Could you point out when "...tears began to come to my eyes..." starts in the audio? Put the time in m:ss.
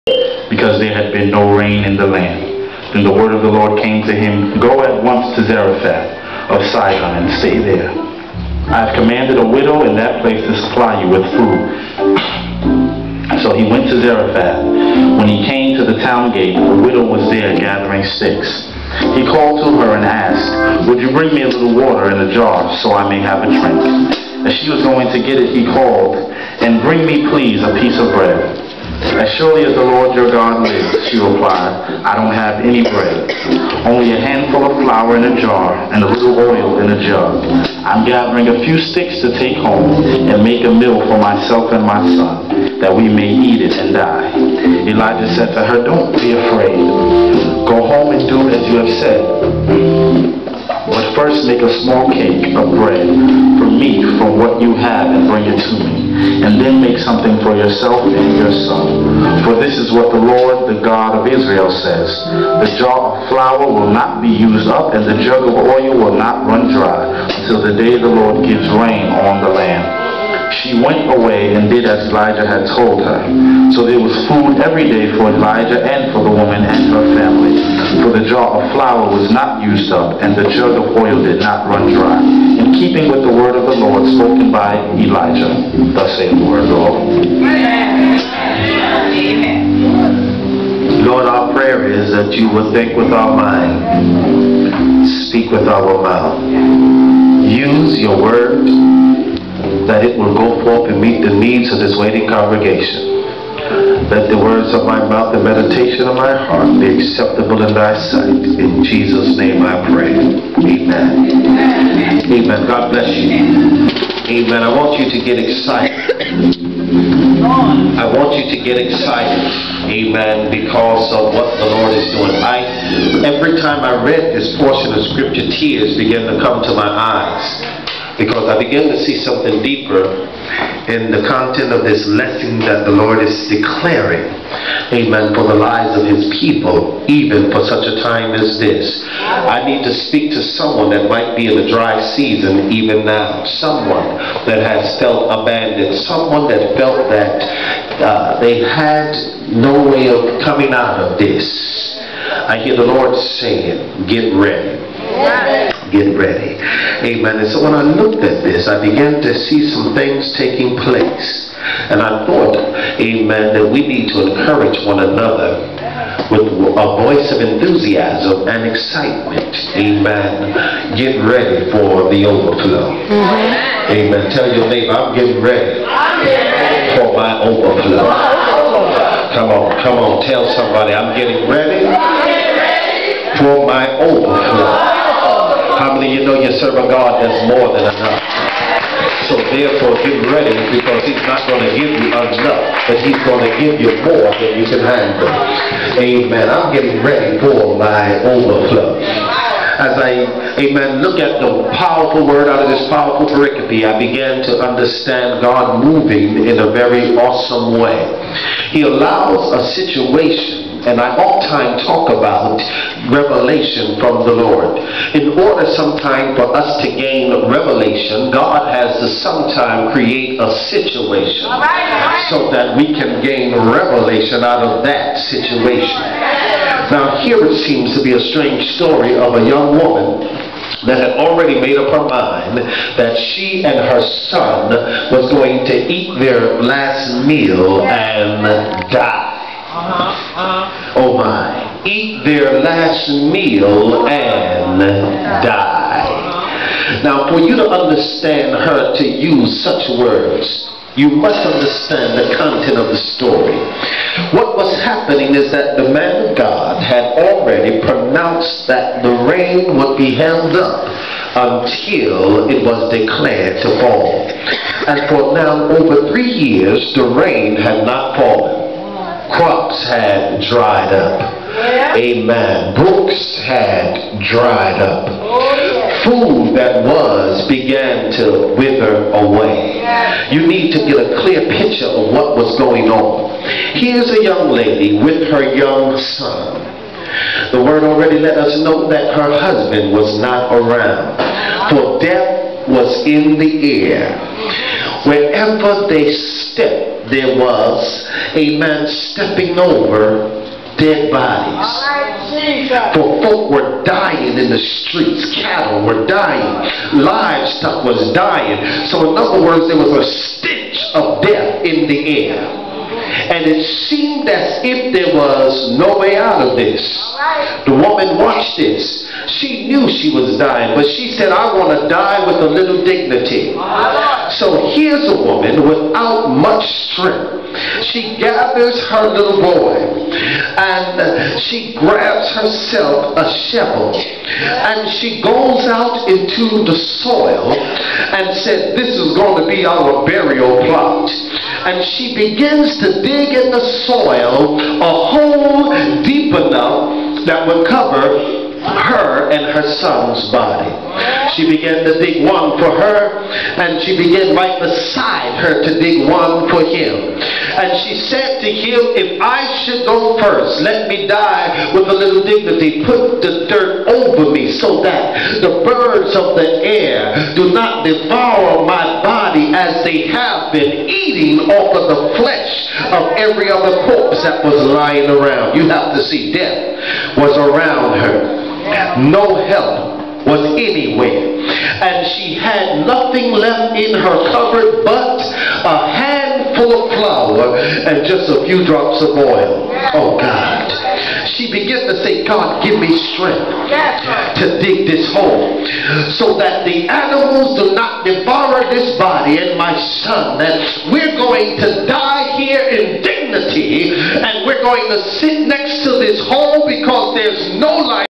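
2:05.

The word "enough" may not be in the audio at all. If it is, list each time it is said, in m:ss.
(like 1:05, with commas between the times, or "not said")
3:07, 3:12, 5:46.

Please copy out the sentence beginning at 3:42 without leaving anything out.
so that we can gain revelation out of that situation.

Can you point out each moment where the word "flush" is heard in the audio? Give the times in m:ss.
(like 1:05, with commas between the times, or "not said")
not said.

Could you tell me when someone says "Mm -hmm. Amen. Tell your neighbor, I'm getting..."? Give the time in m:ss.
2:52.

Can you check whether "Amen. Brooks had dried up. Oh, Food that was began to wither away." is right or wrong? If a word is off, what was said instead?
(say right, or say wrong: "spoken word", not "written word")
right.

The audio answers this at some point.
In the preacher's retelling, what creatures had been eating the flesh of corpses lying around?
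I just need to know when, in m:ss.
6:05.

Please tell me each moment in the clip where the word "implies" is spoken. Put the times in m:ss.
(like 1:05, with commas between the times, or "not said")
not said.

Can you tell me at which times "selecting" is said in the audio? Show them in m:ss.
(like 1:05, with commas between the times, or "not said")
not said.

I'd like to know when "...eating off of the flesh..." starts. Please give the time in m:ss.
6:10.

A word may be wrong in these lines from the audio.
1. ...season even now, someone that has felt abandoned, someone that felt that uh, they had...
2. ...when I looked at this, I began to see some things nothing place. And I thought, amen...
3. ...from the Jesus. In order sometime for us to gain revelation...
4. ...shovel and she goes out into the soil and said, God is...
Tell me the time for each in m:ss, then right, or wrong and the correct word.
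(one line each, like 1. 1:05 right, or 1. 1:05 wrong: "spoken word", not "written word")
1. 2:22 right
2. 2:37 wrong: "taking", not "nothing"
3. 3:33 wrong: "Lord", not "Jesus"
4. 5:33 wrong: "This", not "God".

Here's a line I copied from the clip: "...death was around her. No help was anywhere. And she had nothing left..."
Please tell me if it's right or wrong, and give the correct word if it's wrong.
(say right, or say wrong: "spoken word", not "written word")
right.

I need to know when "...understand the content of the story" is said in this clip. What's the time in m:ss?
4:11.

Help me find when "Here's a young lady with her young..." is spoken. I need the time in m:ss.
4:43.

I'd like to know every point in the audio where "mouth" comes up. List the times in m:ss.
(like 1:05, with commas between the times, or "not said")
1:36, 1:45.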